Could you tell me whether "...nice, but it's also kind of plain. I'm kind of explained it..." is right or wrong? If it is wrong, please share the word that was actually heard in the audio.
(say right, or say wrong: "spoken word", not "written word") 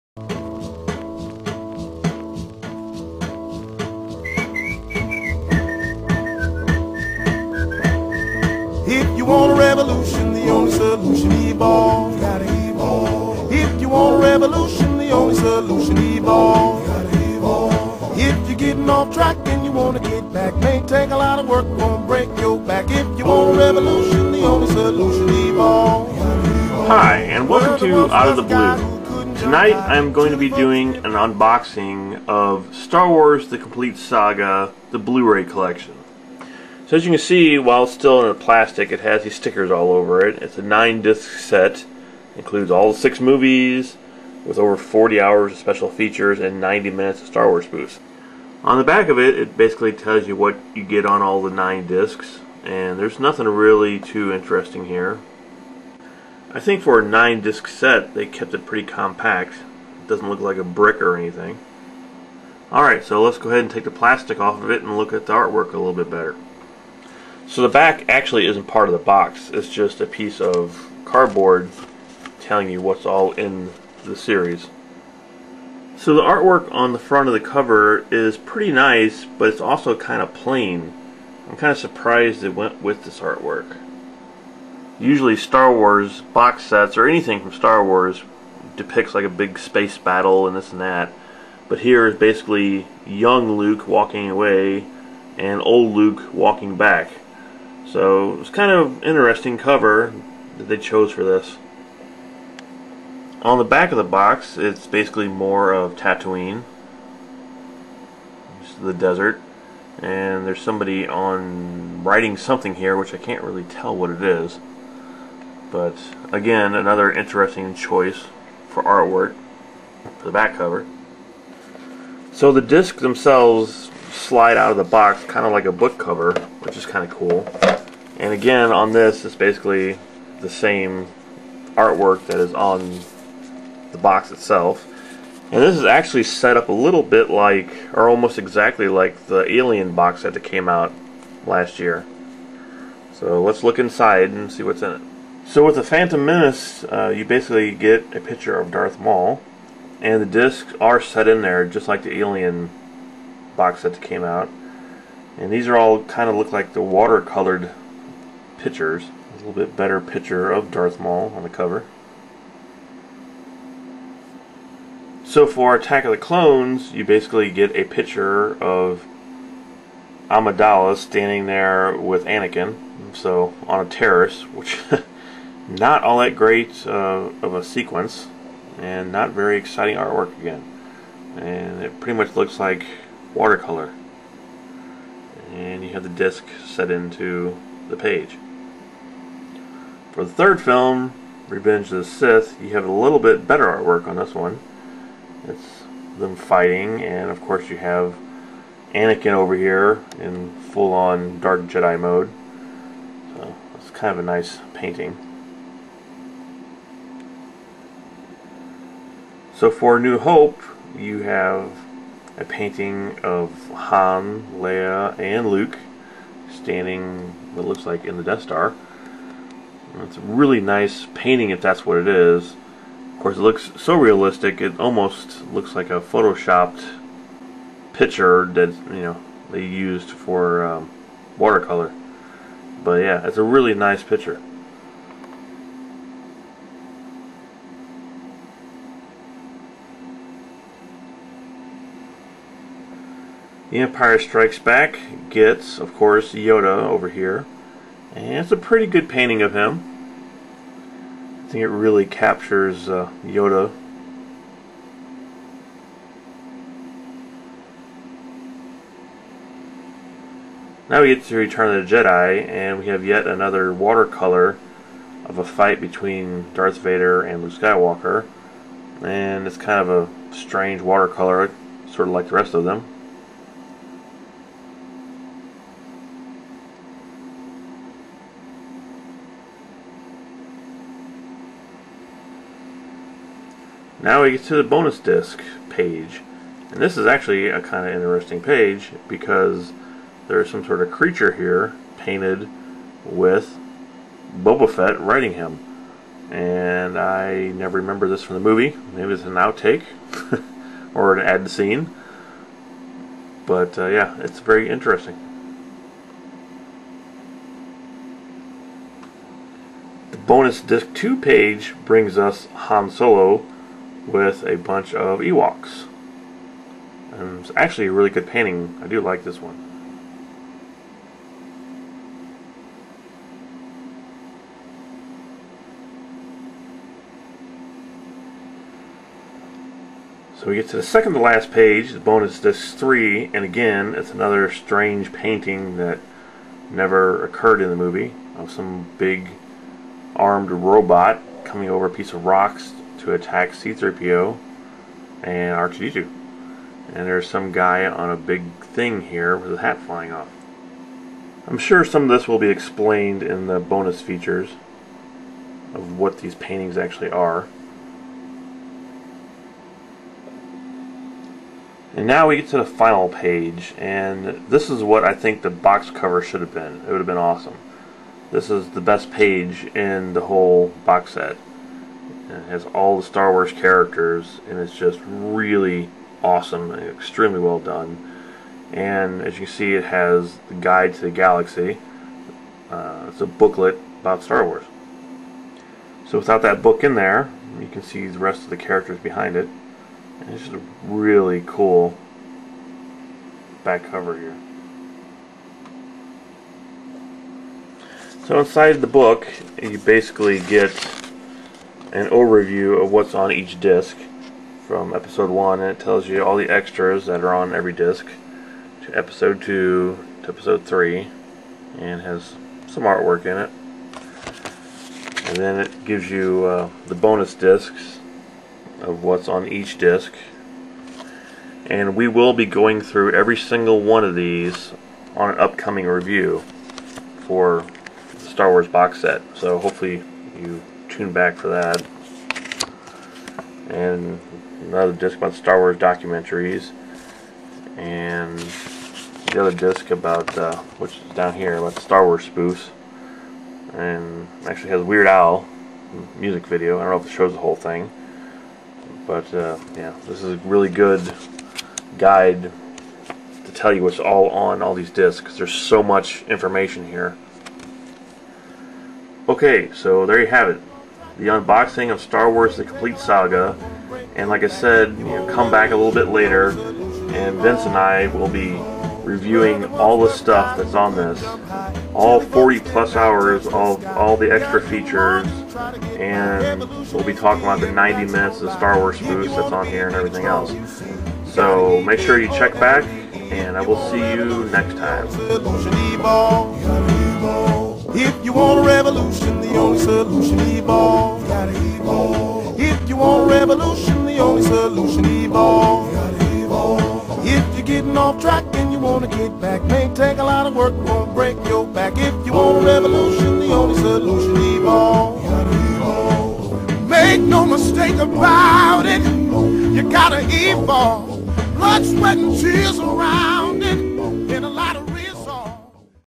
wrong: "surprised", not "explained".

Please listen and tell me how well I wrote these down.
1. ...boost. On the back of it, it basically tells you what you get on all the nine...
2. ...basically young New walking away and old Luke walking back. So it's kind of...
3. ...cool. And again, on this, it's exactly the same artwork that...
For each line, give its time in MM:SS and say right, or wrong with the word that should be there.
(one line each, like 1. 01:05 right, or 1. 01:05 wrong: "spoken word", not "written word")
1. 00:47 right
2. 01:32 wrong: "Luke", not "New"
3. 02:07 wrong: "basically", not "exactly".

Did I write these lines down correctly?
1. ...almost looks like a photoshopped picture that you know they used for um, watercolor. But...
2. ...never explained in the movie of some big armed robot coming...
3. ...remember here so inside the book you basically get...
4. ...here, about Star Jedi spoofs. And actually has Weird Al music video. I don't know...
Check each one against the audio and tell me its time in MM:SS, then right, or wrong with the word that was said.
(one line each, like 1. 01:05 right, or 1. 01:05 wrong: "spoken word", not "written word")
1. 03:44 right
2. 05:36 wrong: "occurred", not "explained"
3. 06:33 wrong: "cover", not "remember"
4. 07:21 wrong: "Wars", not "Jedi".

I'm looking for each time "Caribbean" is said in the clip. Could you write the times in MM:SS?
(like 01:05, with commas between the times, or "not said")
not said.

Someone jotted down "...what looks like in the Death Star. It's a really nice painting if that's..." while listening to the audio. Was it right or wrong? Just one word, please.
right.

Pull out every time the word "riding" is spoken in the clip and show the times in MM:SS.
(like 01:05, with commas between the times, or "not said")
04:54.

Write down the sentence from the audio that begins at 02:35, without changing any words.
And these are all kind of look like the watercolored pictures.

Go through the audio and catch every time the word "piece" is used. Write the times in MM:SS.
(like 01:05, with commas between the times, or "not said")
01:10, 05:41.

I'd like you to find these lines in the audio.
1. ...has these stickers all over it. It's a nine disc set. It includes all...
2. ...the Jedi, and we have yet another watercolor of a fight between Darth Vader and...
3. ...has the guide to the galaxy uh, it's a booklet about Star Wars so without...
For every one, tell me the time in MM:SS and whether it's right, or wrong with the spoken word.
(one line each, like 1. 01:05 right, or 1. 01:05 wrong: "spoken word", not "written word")
1. 00:38 right
2. 04:21 right
3. 06:19 right.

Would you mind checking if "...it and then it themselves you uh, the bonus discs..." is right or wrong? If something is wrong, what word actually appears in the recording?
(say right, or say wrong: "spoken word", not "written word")
wrong: "gives", not "themselves".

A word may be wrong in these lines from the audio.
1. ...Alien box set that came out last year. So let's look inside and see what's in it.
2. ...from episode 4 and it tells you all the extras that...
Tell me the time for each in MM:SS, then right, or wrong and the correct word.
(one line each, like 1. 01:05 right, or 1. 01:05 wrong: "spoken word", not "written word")
1. 02:19 right
2. 06:44 wrong: "1", not "4".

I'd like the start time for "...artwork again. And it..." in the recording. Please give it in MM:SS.
02:59.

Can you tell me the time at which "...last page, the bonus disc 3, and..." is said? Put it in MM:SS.
05:31.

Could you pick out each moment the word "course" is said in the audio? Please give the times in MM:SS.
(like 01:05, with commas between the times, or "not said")
03:17, 03:43, 04:05.